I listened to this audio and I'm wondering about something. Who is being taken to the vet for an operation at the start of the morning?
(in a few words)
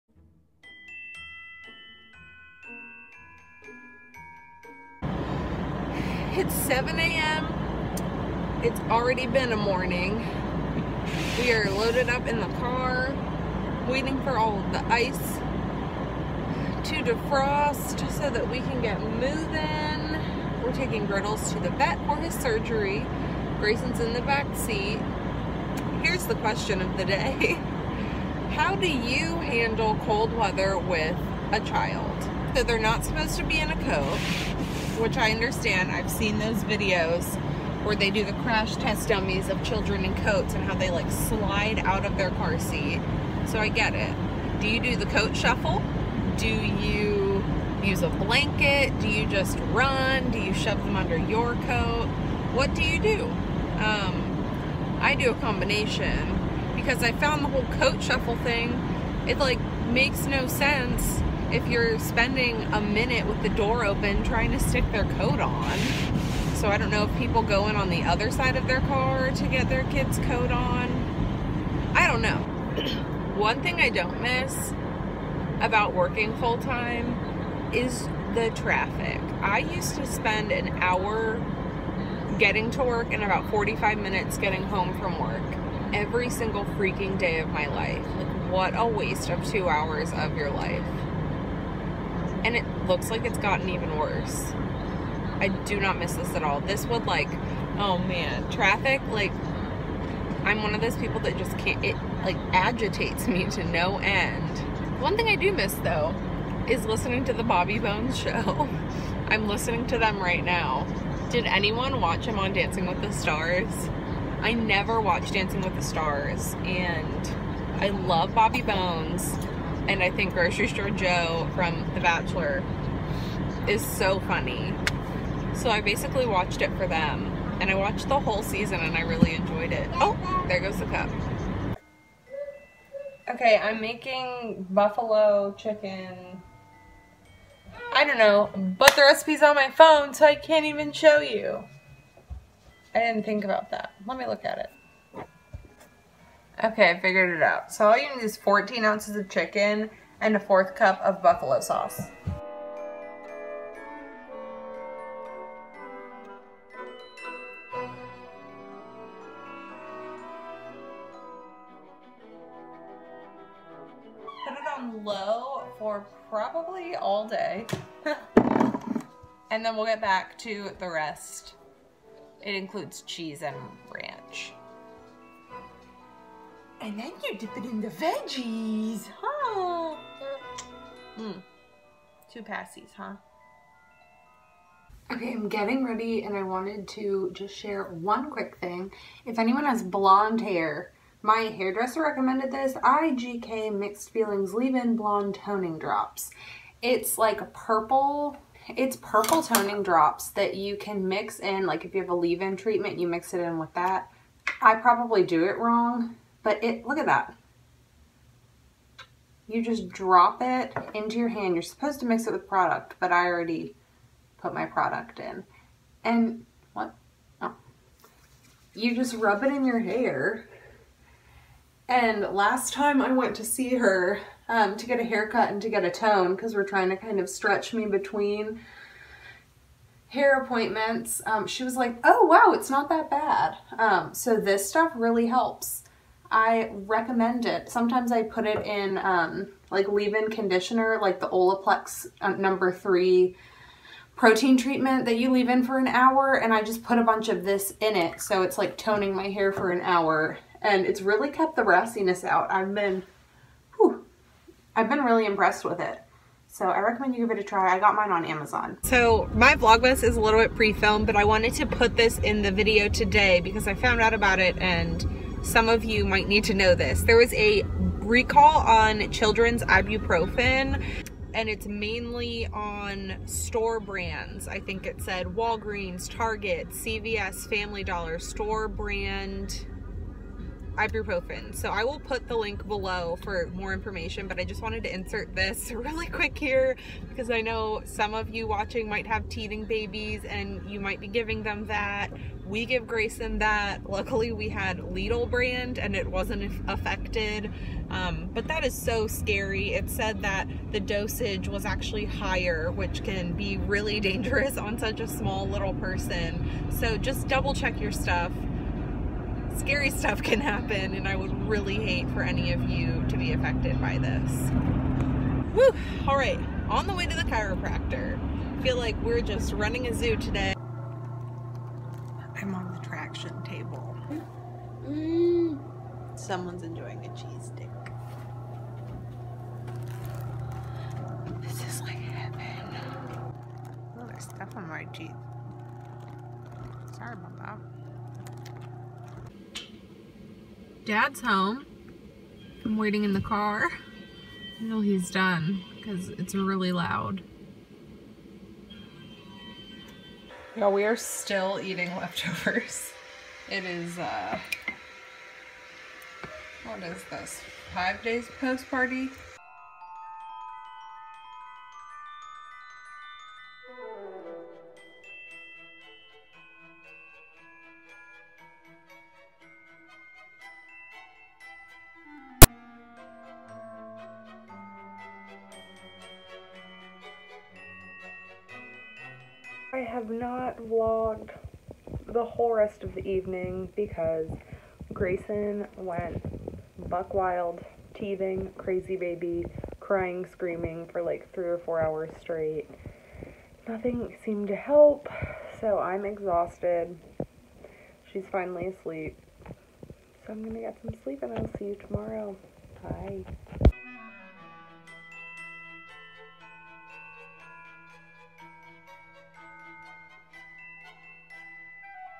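Griddles.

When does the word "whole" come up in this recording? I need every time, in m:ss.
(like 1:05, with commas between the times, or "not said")
0:57, 2:08, 6:22.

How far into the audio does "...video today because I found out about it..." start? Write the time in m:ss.
4:22.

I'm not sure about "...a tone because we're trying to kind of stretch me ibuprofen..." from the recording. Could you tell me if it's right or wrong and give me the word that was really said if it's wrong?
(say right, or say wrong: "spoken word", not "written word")
wrong: "between", not "ibuprofen".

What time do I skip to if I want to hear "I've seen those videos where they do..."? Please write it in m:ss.
0:35.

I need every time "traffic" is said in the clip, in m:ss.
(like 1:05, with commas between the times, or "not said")
1:18, 1:38.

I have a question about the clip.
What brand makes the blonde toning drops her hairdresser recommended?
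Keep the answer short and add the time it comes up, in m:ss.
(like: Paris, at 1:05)
IGK, at 3:12.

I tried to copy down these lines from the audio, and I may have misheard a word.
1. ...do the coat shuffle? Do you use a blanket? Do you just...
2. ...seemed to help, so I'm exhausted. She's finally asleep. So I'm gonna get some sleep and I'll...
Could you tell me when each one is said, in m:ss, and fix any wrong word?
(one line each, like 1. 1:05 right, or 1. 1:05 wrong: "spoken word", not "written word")
1. 0:44 right
2. 6:34 right.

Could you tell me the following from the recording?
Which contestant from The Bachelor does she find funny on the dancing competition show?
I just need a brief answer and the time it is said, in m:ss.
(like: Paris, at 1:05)
Grocery Store Joe, at 2:00.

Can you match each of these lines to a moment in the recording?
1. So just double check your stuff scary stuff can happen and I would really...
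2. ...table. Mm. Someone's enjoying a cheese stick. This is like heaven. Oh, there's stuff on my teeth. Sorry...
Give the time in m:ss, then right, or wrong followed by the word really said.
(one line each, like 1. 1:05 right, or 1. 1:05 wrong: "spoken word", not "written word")
1. 5:06 right
2. 5:23 right.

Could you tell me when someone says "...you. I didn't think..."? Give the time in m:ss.
2:21.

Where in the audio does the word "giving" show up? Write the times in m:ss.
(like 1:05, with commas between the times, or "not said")
4:51.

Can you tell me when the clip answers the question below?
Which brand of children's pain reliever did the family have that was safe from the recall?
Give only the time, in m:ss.
4:54.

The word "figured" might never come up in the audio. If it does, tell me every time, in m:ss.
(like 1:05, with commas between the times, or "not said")
2:26.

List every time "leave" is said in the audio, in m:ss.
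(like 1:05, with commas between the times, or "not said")
3:14, 3:22, 3:59, 4:05.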